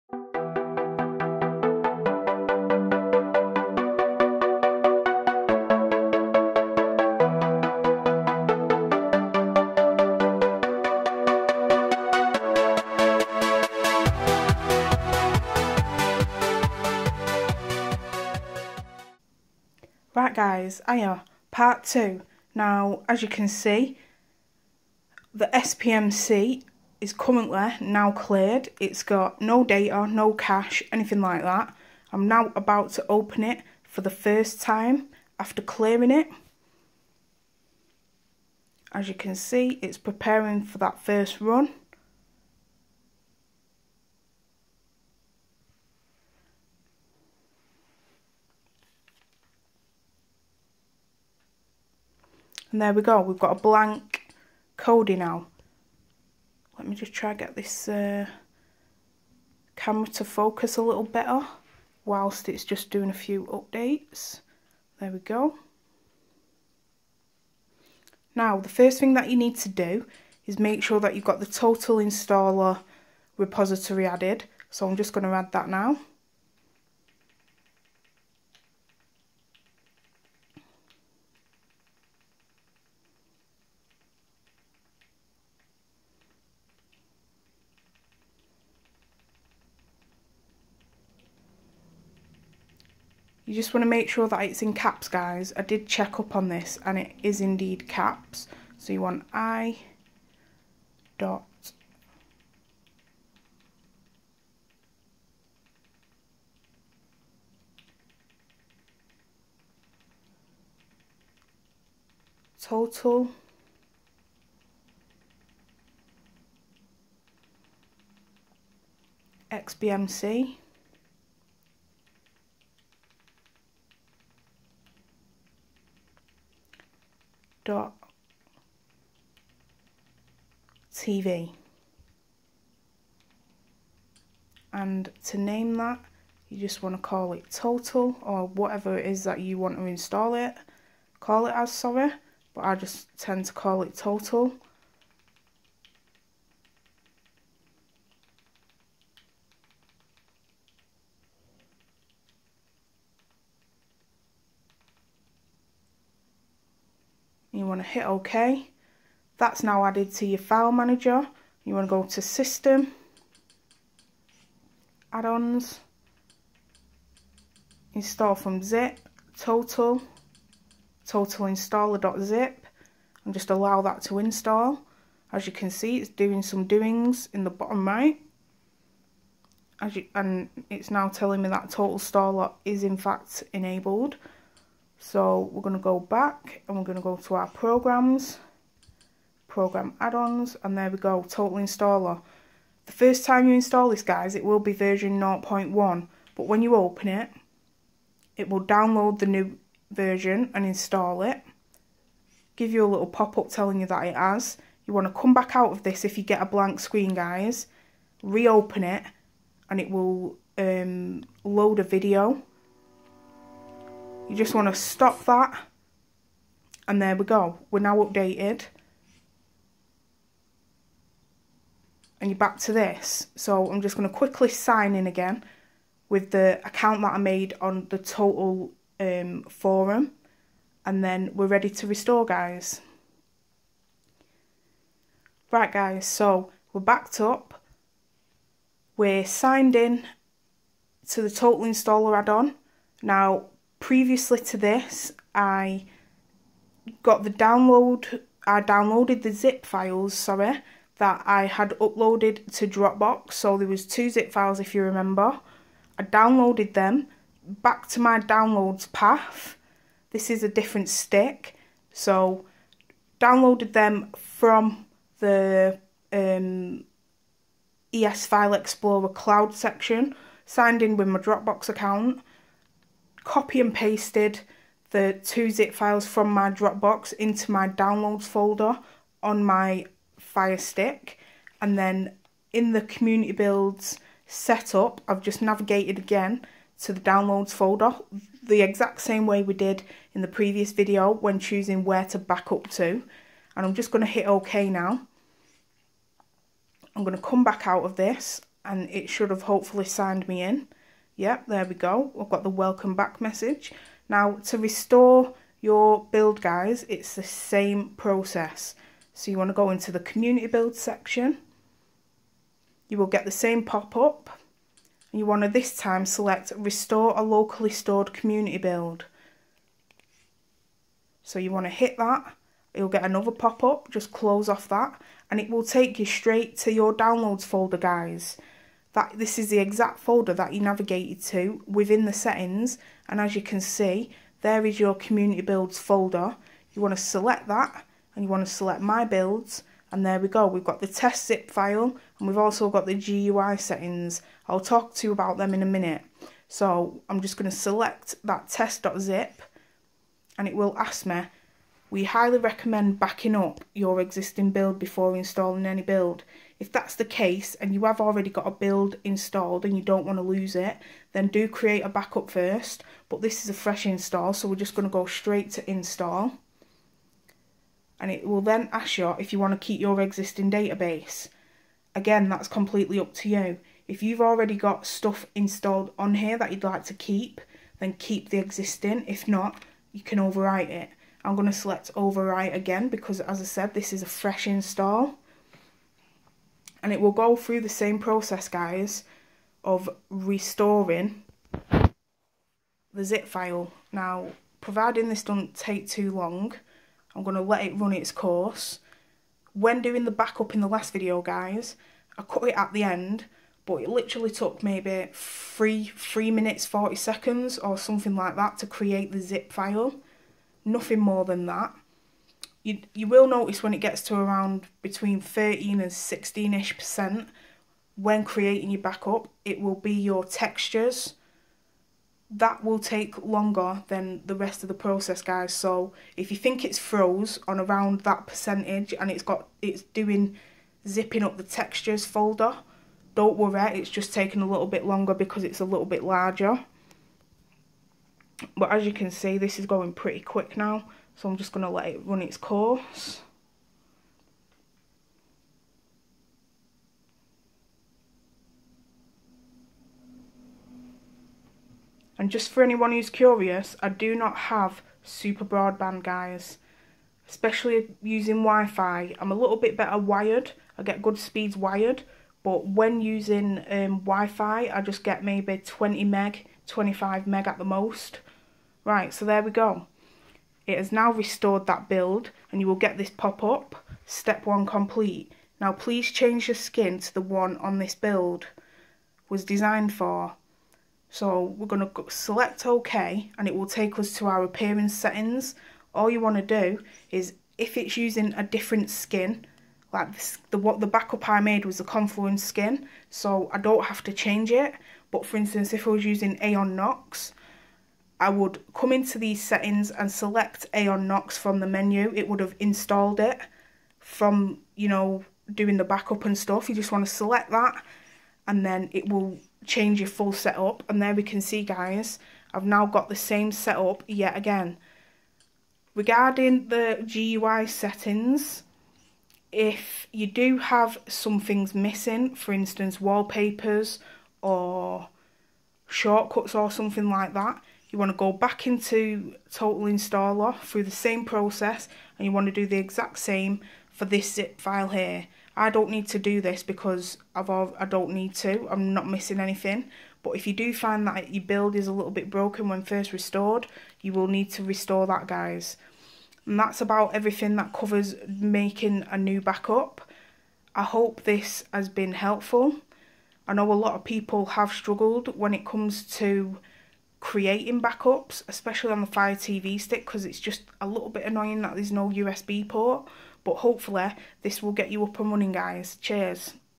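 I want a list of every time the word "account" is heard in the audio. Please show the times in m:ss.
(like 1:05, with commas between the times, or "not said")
3:46, 4:31.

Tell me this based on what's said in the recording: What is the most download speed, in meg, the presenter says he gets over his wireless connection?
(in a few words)
25.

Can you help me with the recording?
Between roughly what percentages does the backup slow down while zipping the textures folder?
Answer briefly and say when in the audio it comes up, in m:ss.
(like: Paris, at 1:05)
13 and 16, at 6:54.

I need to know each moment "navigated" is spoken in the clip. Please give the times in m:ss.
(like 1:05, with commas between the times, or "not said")
4:45, 5:30.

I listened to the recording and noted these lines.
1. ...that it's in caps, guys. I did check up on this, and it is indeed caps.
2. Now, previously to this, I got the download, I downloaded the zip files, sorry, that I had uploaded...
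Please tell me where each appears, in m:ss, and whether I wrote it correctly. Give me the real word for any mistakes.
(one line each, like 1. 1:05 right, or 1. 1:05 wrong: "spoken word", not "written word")
1. 1:34 right
2. 4:03 right.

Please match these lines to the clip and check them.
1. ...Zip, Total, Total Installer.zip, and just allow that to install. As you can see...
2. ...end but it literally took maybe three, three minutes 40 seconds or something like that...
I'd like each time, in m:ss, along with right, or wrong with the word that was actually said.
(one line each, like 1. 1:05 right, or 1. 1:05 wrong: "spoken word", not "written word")
1. 2:48 right
2. 6:42 right.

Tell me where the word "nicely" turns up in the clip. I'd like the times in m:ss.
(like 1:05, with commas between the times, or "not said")
not said.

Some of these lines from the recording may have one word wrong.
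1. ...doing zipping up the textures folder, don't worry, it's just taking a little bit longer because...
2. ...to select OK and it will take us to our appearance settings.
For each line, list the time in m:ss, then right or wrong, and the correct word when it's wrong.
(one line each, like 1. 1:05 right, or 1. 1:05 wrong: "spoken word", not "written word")
1. 7:09 right
2. 8:01 right.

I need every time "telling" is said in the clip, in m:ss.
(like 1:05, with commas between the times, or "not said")
3:01, 3:23.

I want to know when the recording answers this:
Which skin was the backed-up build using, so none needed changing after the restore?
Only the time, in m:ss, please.
8:11.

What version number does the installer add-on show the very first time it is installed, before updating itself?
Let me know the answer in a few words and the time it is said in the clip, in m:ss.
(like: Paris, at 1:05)
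0.1, at 3:14.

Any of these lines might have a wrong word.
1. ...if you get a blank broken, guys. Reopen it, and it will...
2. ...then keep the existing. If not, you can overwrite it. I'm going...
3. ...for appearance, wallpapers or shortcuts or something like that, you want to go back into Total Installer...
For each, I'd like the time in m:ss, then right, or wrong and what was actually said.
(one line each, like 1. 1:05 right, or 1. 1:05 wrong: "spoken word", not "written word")
1. 3:26 wrong: "screen", not "broken"
2. 6:17 right
3. 8:42 wrong: "instance", not "appearance".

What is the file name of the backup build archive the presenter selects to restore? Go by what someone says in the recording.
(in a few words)
test.zip.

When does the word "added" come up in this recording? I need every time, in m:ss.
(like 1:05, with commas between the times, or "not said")
1:14, 2:39.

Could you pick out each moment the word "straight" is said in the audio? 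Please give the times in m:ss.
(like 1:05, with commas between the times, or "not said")
5:26, 6:05.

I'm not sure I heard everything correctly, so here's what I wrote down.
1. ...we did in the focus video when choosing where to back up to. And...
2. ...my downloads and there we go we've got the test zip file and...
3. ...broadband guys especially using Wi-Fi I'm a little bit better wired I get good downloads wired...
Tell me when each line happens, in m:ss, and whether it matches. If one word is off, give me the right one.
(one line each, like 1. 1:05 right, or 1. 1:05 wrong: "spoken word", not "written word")
1. 4:49 wrong: "previous", not "focus"
2. 5:38 wrong: "builds", not "downloads"
3. 7:35 wrong: "speeds", not "downloads".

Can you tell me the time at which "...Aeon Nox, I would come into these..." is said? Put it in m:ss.
8:16.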